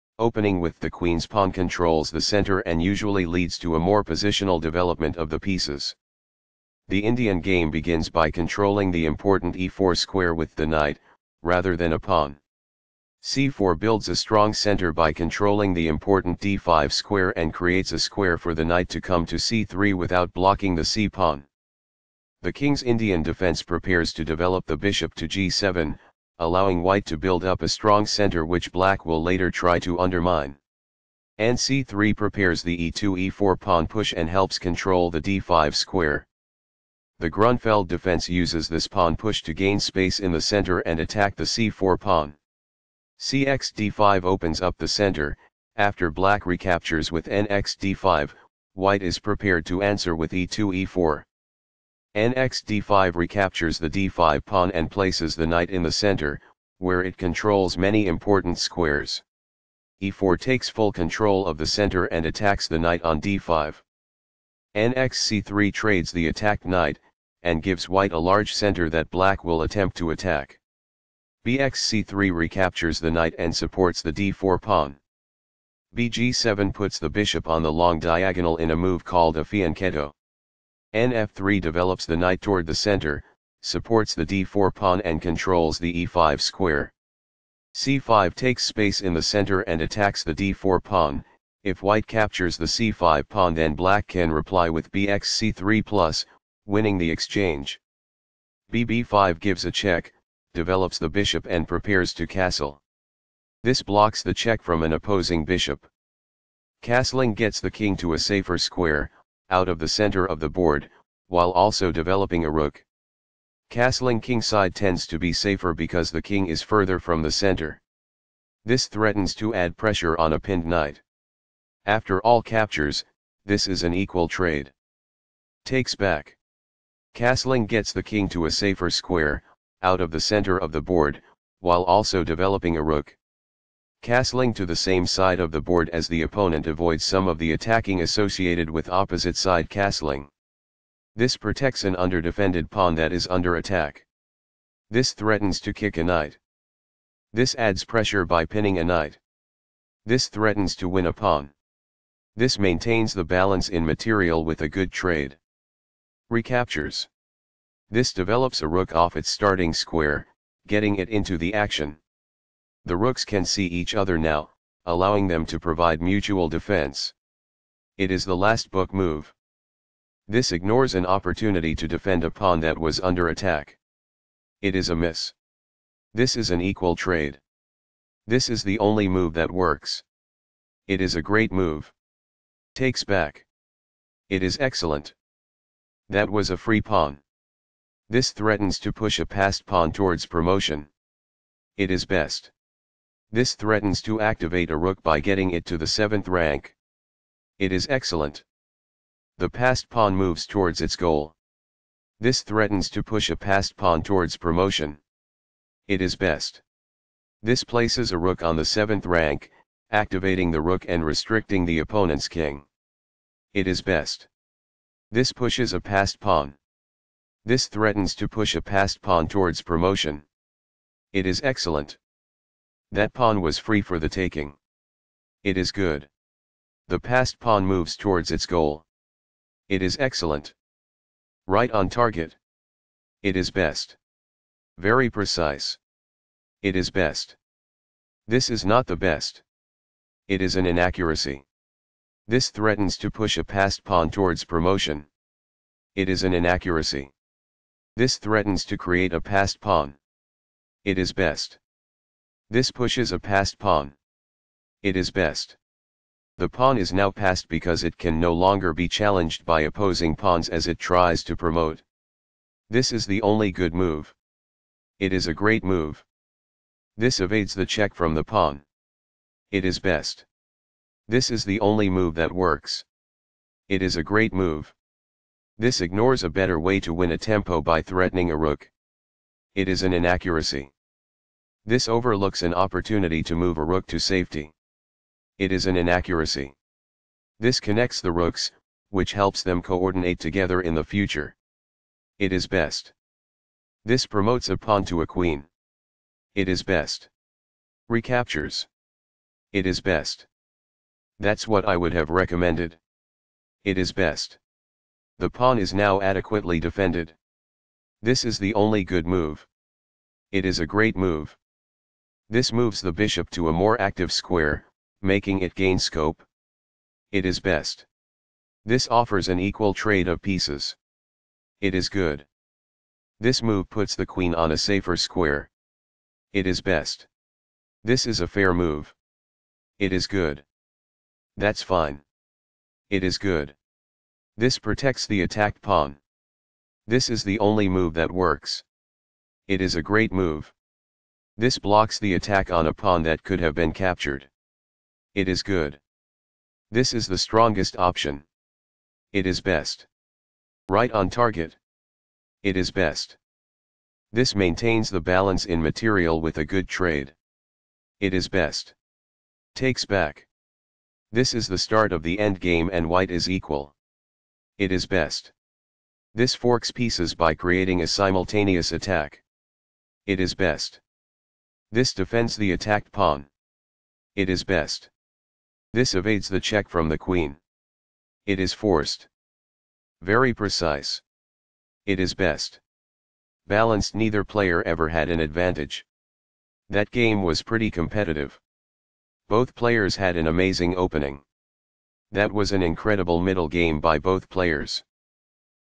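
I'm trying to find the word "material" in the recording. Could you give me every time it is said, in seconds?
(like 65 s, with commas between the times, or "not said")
153 s, 355 s.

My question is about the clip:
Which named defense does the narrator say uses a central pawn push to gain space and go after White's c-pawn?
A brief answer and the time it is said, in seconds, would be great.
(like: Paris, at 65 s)
Grunfeld defense, at 37 s.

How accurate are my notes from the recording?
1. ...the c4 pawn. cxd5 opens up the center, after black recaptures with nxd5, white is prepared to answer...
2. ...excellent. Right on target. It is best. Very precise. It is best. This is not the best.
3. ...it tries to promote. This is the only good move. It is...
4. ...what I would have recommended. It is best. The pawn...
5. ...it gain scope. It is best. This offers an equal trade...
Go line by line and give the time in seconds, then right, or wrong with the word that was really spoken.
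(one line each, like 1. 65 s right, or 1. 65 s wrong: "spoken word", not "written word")
1. 41 s right
2. 229 s right
3. 260 s right
4. 301 s right
5. 315 s right.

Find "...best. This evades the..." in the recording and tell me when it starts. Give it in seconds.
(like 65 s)
374 s.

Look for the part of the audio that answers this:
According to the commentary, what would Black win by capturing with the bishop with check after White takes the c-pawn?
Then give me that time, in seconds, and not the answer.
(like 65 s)
96 s.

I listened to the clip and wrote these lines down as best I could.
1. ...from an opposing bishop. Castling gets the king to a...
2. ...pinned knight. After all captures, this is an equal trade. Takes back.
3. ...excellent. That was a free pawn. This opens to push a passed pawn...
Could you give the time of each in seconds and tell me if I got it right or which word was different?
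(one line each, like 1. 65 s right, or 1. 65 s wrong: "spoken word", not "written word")
1. 104 s right
2. 120 s right
3. 184 s wrong: "threatens", not "opens".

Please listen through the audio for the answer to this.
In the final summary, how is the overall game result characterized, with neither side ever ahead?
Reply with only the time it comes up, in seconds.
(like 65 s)
383 s.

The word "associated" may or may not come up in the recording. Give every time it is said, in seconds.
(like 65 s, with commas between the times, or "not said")
138 s.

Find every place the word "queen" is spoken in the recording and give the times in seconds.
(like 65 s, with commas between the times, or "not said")
0 s, 295 s, 324 s, 376 s.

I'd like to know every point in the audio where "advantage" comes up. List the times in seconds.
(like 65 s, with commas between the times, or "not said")
385 s.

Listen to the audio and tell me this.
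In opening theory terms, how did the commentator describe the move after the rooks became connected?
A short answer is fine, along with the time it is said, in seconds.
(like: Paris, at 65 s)
last book move, at 168 s.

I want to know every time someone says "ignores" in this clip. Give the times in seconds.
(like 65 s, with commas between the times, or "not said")
170 s, 275 s.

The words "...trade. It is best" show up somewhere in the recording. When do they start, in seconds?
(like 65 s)
356 s.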